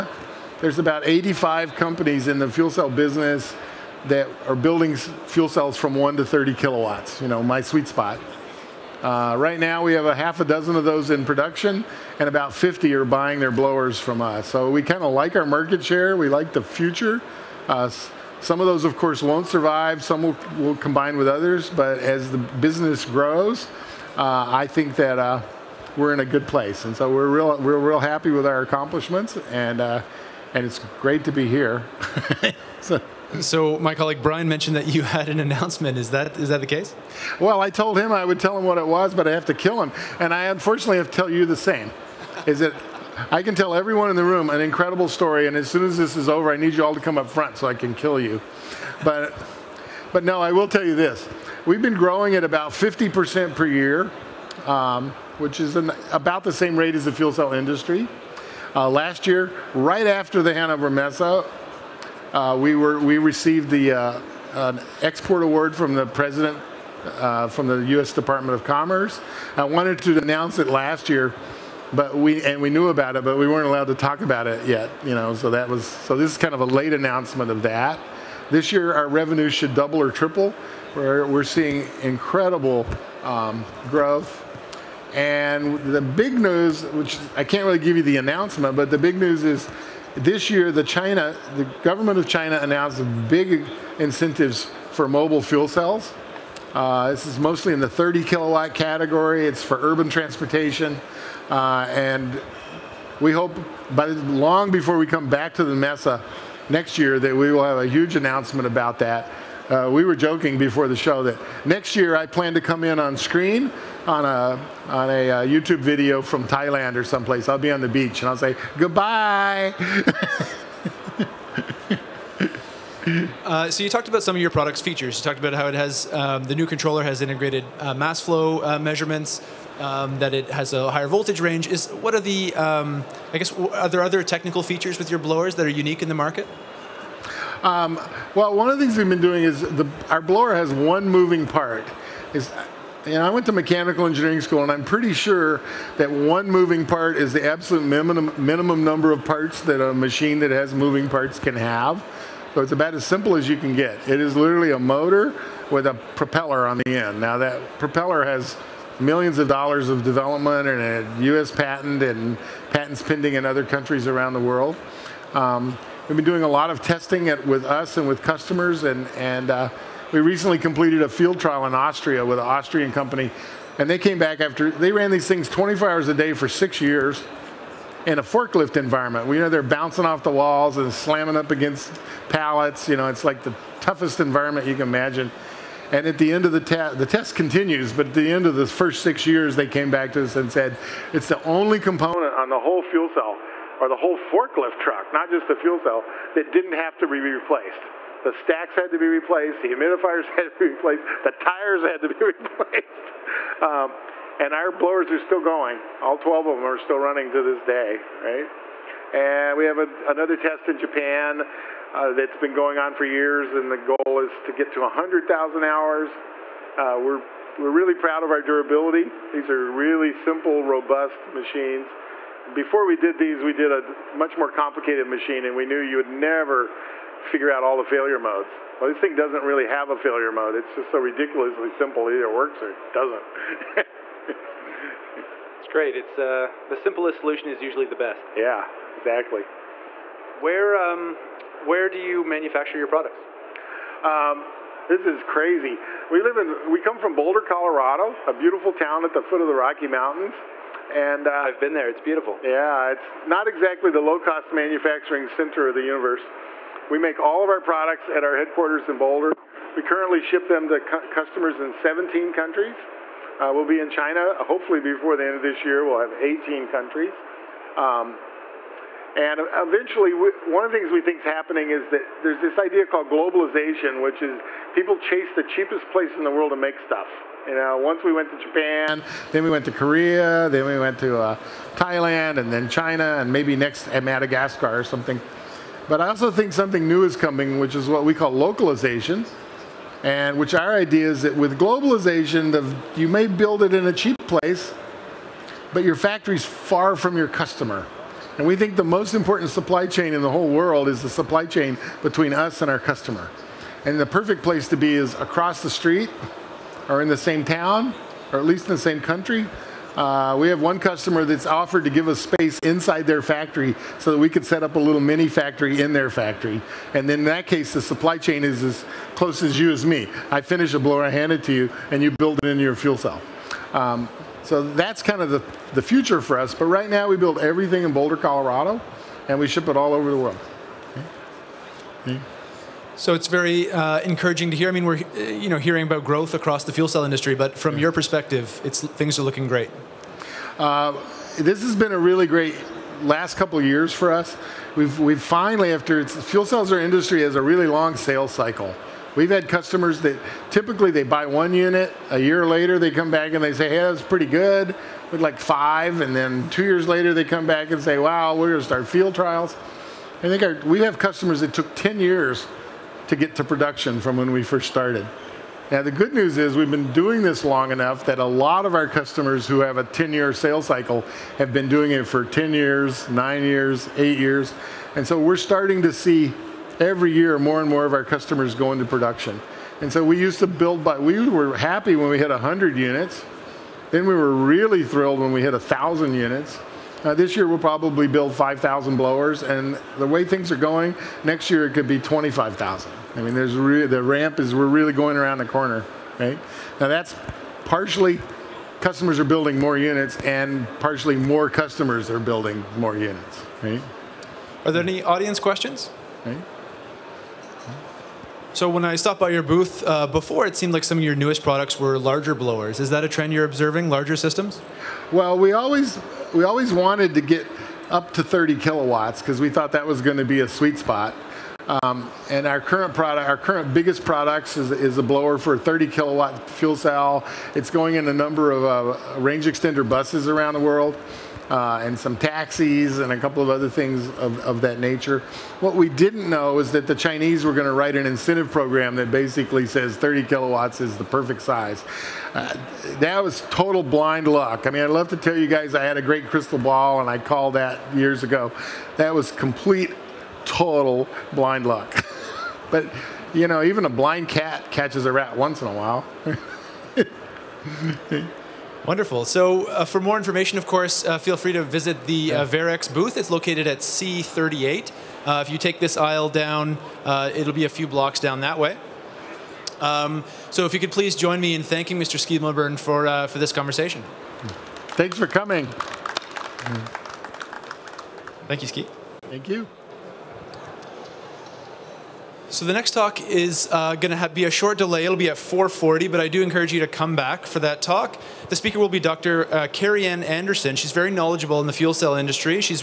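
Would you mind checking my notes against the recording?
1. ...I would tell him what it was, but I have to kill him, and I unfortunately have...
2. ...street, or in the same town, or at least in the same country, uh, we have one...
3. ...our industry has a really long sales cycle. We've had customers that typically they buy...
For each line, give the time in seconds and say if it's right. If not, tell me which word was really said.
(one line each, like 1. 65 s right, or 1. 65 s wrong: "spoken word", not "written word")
1. 38 s right
2. 305 s right
3. 346 s right.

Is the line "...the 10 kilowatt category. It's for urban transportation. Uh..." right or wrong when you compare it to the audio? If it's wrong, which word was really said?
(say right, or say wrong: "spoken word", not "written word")
wrong: "30", not "10".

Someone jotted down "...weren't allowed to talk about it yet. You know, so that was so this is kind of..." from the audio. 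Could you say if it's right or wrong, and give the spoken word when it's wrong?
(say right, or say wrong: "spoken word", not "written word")
right.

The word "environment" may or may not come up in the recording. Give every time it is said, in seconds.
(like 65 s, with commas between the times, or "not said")
178 s, 184 s.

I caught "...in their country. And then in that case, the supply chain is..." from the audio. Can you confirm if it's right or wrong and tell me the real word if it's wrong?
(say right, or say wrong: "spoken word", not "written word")
wrong: "factory", not "country".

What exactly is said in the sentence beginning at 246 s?
We live in we come from Boulder, Colorado, a beautiful town at the foot of the Rocky Mountains.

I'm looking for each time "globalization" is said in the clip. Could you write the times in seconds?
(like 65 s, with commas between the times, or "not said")
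273 s, 291 s.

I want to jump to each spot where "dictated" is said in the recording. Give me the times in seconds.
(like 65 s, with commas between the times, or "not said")
not said.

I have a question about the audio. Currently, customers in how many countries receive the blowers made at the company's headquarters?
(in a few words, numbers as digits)
17.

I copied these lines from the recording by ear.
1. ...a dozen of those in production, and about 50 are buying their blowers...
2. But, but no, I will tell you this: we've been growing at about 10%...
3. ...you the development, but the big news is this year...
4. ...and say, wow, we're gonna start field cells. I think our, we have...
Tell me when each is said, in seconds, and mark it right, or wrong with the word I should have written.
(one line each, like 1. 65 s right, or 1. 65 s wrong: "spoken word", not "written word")
1. 10 s right
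2. 49 s wrong: "50", not "10"
3. 87 s wrong: "announcement", not "development"
4. 357 s wrong: "trials", not "cells".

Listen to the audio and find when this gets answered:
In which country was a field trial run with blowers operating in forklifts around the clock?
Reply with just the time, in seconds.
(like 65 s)
171 s.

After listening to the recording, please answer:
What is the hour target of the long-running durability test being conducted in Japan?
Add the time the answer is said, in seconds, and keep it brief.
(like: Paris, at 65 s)
100,000 hours, at 214 s.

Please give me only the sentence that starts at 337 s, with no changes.
your perspective, it's things are looking great.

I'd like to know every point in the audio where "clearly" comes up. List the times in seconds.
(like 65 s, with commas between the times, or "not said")
not said.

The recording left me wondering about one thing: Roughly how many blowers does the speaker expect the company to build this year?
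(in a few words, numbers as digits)
5,000.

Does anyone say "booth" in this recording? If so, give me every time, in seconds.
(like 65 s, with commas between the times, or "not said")
409 s, 462 s.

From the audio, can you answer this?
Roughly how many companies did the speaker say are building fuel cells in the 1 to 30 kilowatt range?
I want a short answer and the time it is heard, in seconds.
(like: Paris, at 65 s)
85, at 1 s.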